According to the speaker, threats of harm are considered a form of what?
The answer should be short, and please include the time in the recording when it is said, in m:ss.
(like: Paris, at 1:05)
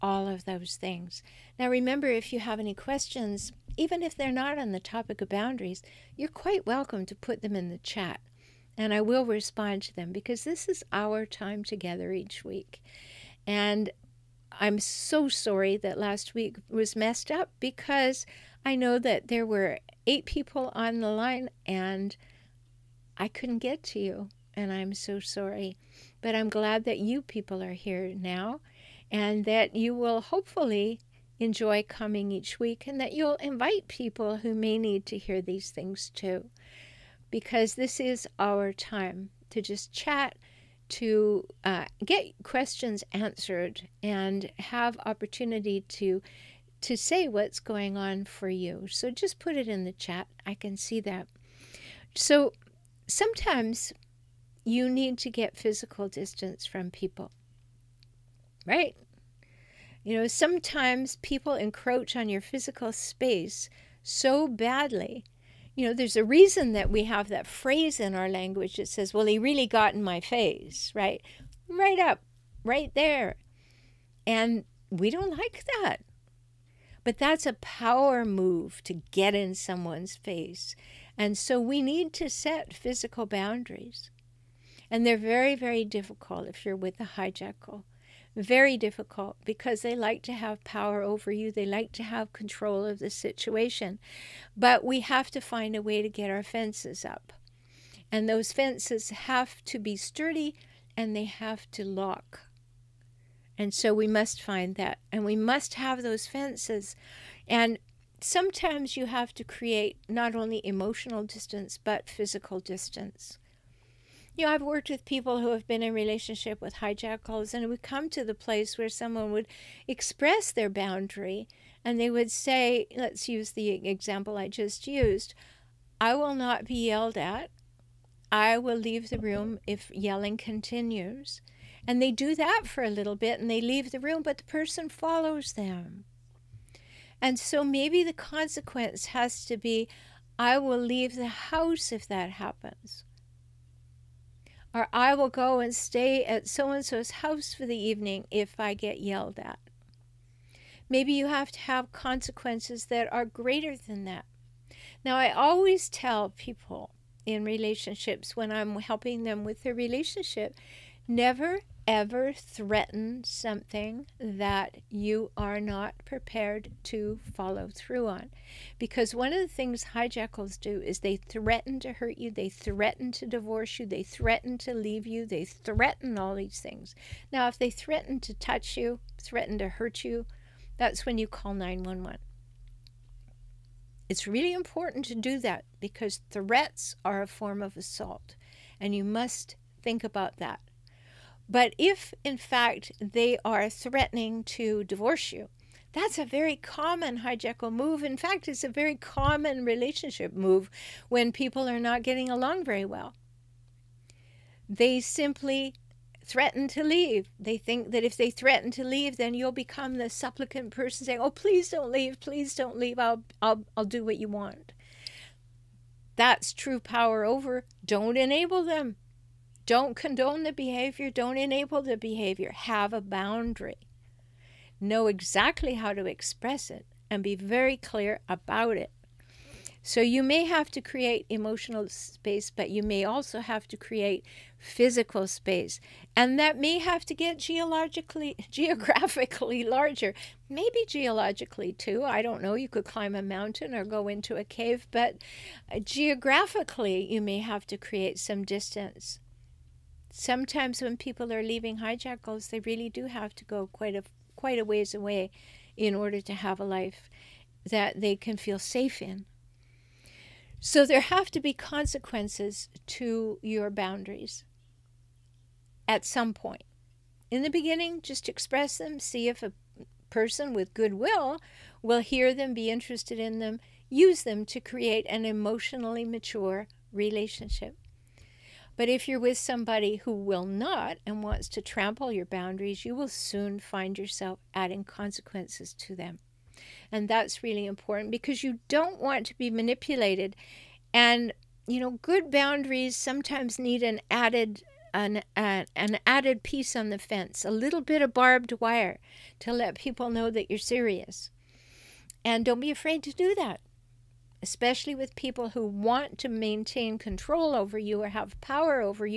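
assault, at 3:07.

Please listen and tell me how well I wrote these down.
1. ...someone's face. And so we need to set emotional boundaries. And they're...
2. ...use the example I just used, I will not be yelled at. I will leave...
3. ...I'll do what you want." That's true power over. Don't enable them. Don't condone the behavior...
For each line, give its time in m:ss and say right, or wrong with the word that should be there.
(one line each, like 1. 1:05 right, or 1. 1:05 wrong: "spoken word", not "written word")
1. 1:19 wrong: "physical", not "emotional"
2. 2:03 right
3. 3:33 right.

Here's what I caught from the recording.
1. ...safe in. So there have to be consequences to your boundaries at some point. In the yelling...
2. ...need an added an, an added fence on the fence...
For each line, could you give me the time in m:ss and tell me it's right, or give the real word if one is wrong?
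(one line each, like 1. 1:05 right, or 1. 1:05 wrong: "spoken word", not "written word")
1. 4:18 wrong: "beginning", not "yelling"
2. 4:53 wrong: "piece", not "fence".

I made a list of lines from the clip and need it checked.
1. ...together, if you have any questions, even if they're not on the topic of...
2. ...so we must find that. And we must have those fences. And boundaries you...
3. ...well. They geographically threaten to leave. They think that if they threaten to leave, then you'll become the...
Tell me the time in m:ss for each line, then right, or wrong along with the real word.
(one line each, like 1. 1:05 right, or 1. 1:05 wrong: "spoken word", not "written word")
1. 0:01 wrong: "remember", not "together"
2. 1:43 wrong: "sometimes", not "boundaries"
3. 3:22 wrong: "simply", not "geographically".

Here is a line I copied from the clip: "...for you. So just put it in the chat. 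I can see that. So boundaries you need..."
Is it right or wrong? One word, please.
wrong.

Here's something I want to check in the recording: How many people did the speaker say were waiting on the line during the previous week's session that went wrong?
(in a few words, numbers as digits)
8.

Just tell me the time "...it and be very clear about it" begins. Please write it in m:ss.
3:46.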